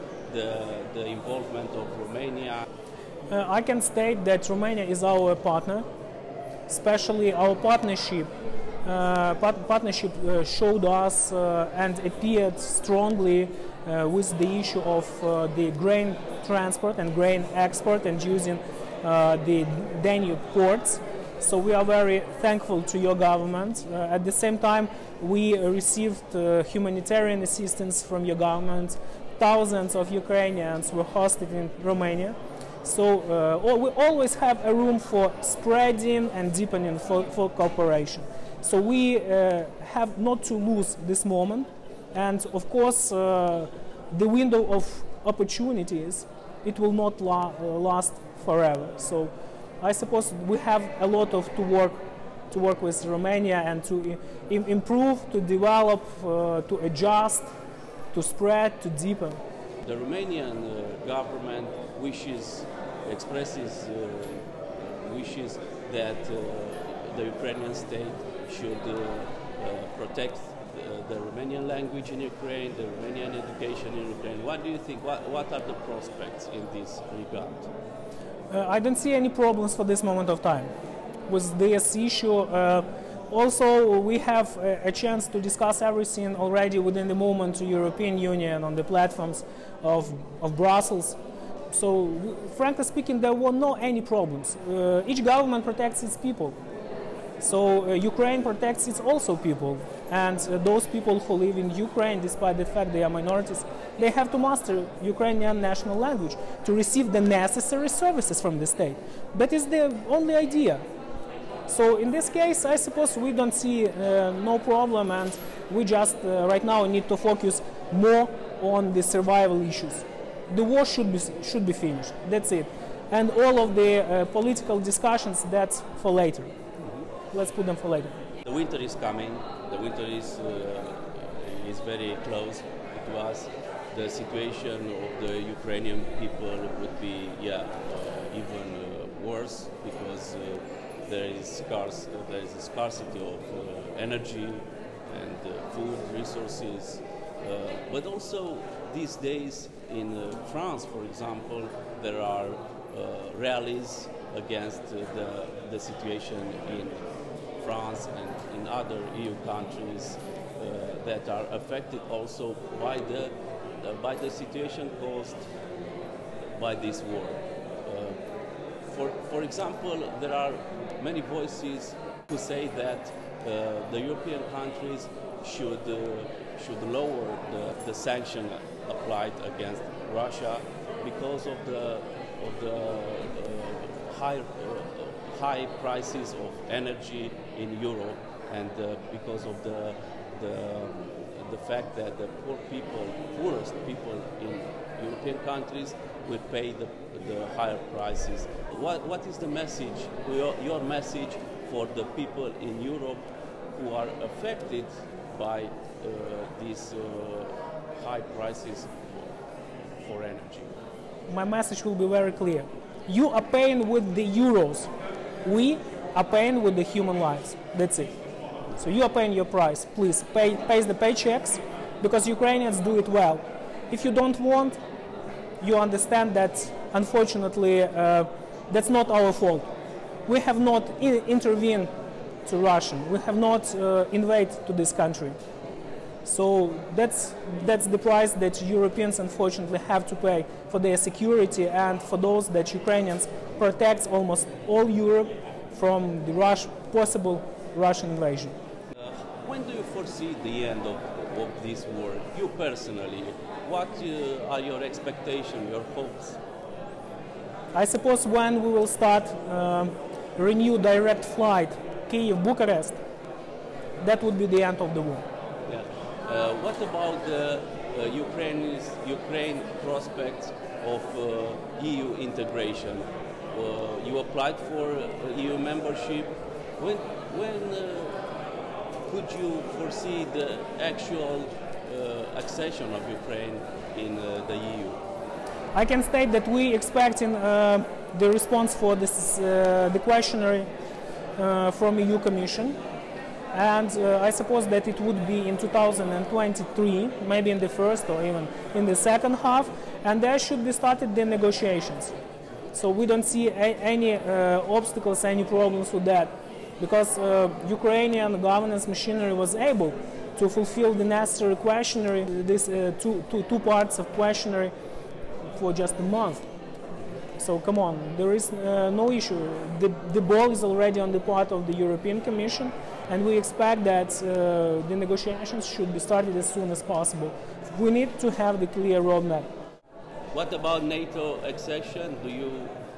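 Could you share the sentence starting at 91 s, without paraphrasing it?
So, frankly speaking, there were no any problems.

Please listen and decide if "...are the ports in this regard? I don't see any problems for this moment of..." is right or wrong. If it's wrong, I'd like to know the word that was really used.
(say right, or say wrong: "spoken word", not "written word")
wrong: "prospects", not "ports".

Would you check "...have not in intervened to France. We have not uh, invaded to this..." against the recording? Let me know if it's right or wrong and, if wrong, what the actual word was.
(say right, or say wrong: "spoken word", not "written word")
wrong: "Russia", not "France".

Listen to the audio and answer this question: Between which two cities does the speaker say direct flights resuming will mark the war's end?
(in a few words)
Kiev-Bucharest.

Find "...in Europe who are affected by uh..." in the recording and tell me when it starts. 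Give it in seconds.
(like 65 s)
202 s.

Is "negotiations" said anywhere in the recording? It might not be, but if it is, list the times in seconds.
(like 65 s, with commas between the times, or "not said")
301 s, 325 s.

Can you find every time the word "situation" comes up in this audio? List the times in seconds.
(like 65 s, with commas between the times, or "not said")
134 s, 155 s, 164 s.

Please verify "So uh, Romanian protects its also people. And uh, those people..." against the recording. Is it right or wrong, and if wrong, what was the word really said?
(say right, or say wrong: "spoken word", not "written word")
wrong: "Ukraine", not "Romanian".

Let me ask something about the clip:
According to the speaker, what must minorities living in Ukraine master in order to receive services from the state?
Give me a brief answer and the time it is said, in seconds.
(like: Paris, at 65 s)
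Ukrainian national language, at 105 s.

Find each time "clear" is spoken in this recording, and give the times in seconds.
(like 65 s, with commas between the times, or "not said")
212 s, 328 s.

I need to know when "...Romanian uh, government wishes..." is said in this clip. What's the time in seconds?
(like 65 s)
59 s.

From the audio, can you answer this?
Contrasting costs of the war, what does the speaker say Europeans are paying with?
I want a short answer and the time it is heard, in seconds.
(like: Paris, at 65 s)
Euros, at 214 s.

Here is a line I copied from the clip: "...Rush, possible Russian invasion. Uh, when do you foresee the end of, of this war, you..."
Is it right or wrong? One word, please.
right.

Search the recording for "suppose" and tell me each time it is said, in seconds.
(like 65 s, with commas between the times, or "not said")
49 s, 112 s, 257 s, 294 s.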